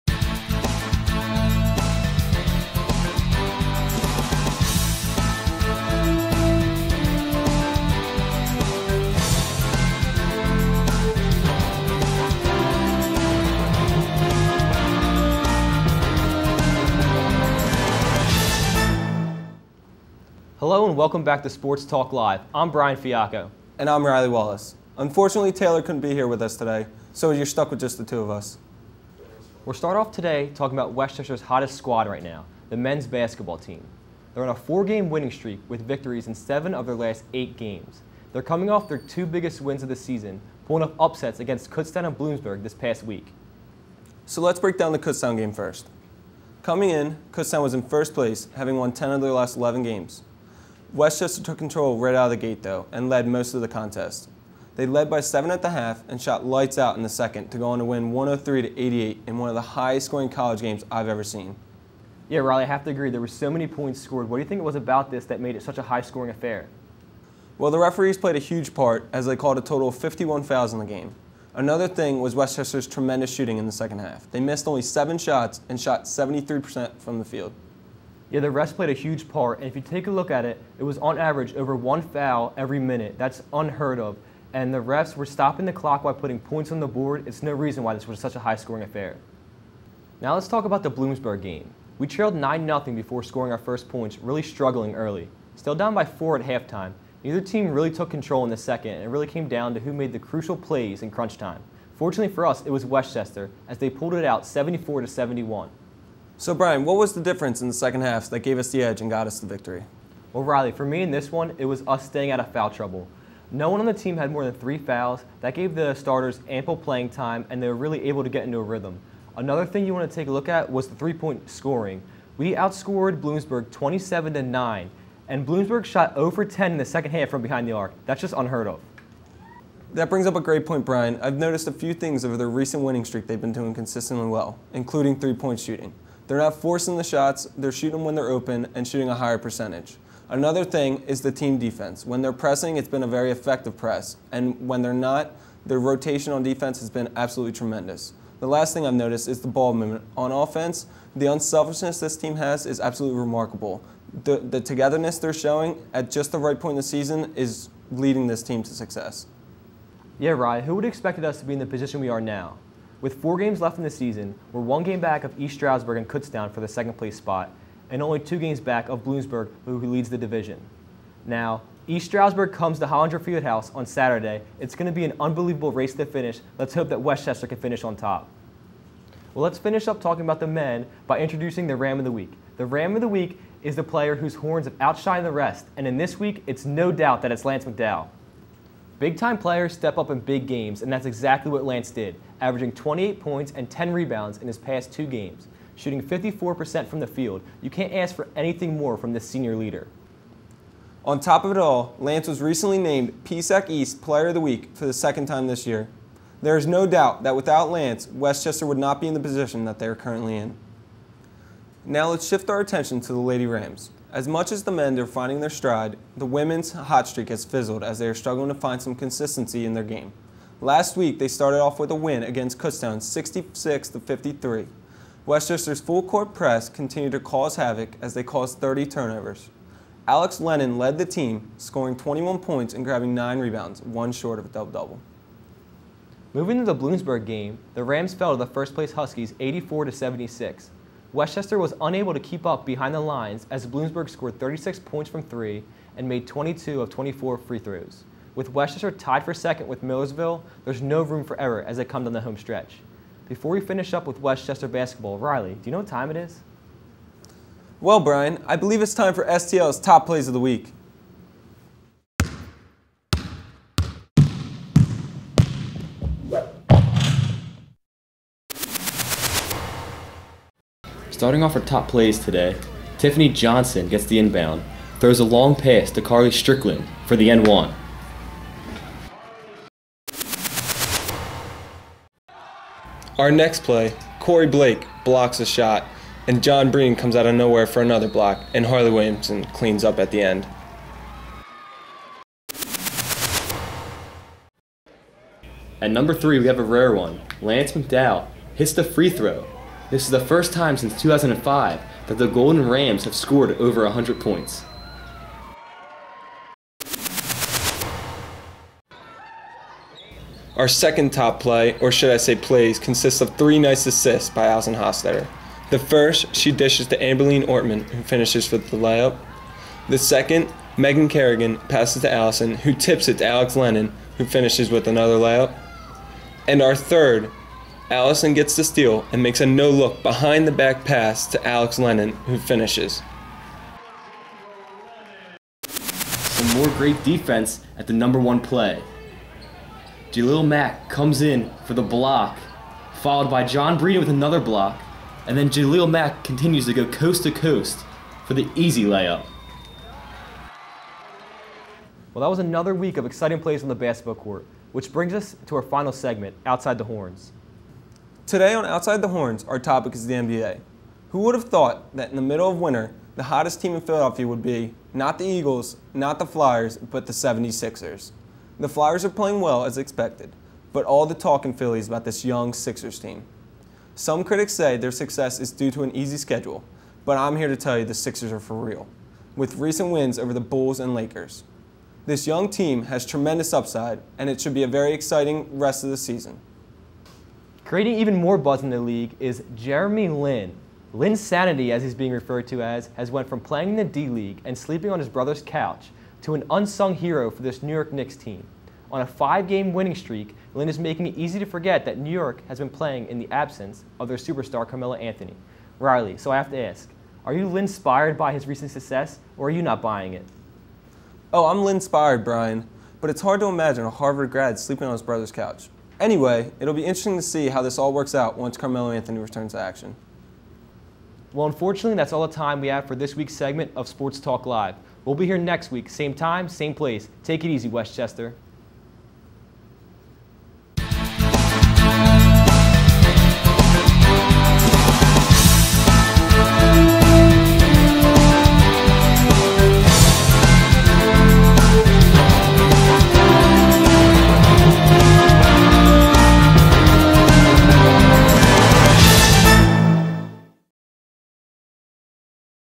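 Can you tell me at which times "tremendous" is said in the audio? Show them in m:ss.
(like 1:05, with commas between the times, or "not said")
1:12, 2:27, 6:23.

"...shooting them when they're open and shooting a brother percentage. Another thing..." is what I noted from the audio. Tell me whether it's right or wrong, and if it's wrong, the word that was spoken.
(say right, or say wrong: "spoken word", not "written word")
wrong: "higher", not "brother".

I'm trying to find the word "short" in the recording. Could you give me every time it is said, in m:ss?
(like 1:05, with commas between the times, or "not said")
3:54.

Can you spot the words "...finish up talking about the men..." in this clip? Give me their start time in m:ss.
2:59.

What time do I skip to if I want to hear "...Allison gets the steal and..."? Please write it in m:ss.
5:27.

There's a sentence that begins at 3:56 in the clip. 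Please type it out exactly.
Moving to the Bloomsburg game, the Rams fell to the first place Huskies 84 to 76.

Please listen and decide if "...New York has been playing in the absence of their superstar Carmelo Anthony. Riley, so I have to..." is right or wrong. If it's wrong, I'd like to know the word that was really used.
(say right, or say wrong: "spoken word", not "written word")
right.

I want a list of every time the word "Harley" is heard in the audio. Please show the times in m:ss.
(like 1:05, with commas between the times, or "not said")
4:48.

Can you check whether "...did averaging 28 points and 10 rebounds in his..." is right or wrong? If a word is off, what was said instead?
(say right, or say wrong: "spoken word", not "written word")
right.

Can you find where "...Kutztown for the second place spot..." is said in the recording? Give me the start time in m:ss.
2:46.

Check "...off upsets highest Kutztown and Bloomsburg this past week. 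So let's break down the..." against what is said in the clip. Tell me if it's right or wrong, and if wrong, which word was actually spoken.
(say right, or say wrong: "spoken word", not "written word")
wrong: "against", not "highest".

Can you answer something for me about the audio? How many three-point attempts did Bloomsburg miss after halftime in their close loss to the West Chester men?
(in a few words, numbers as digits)
10.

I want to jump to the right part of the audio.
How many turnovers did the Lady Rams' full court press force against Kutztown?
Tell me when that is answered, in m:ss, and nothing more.
3:48.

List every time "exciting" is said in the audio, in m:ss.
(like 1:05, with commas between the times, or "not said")
5:53, 6:24.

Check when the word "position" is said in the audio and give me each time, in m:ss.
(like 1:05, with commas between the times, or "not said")
2:41, 3:29.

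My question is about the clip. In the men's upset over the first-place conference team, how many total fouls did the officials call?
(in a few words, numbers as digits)
51.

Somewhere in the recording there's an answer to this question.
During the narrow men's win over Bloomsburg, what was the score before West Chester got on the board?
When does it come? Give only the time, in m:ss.
1:32.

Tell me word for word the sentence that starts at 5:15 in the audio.
The first, she dishes to Amberlene Ortman, who finishes with the layup.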